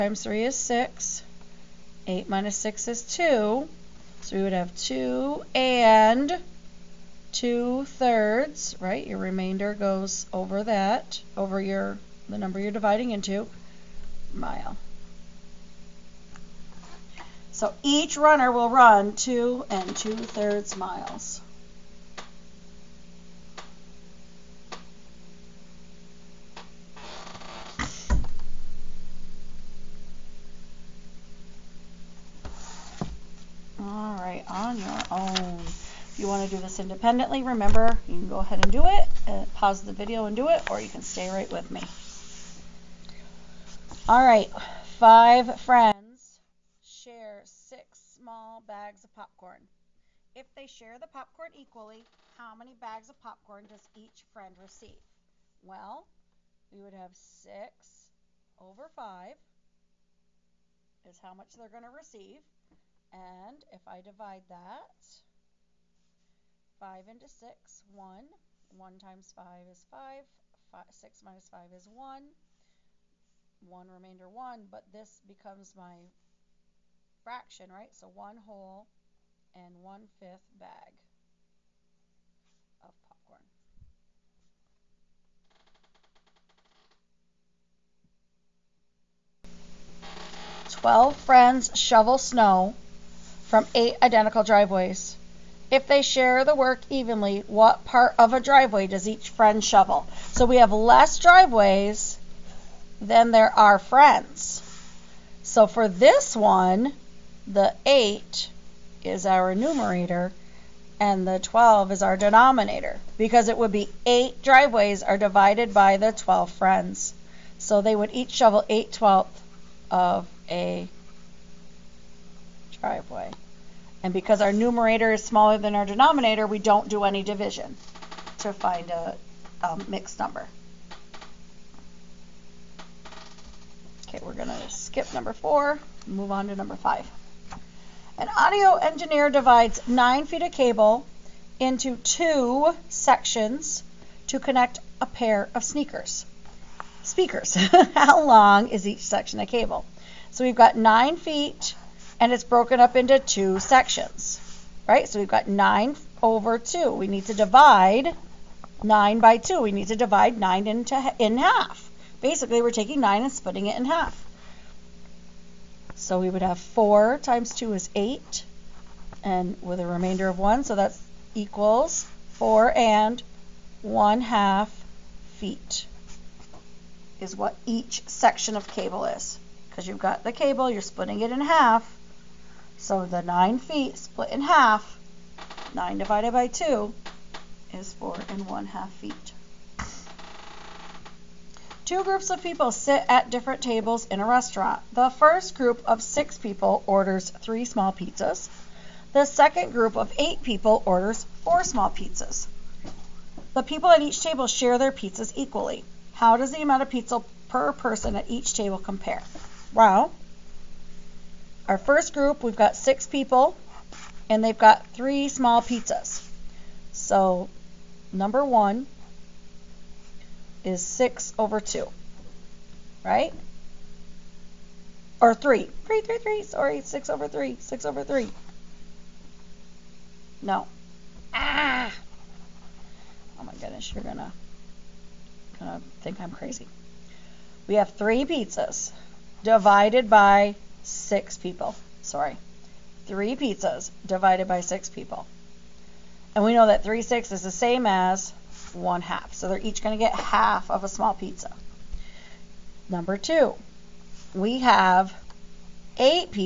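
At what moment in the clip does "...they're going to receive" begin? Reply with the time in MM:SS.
01:01.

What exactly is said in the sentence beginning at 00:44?
All right, five friends share six small bags of popcorn.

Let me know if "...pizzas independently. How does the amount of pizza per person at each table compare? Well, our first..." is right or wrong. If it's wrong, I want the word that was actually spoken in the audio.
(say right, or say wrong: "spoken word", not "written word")
wrong: "equally", not "independently".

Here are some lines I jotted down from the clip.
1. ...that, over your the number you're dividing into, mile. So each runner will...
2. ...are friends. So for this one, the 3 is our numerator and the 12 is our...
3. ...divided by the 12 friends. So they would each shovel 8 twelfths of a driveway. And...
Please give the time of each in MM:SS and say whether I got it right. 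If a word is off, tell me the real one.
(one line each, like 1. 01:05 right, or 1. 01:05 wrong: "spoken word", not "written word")
1. 00:10 right
2. 01:43 wrong: "8", not "3"
3. 01:55 right.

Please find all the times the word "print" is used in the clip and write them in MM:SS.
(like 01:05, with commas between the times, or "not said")
not said.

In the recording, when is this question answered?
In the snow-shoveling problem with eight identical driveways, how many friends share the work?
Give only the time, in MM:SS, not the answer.
01:30.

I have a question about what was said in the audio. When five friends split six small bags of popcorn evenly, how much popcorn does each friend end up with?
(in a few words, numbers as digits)
1 and 1/5 bags.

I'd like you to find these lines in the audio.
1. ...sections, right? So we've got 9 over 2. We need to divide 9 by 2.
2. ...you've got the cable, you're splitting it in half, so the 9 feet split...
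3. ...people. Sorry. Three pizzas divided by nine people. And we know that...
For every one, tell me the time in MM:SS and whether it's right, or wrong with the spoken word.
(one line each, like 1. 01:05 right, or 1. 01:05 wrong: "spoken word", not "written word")
1. 02:33 right
2. 02:59 right
3. 04:01 wrong: "six", not "nine".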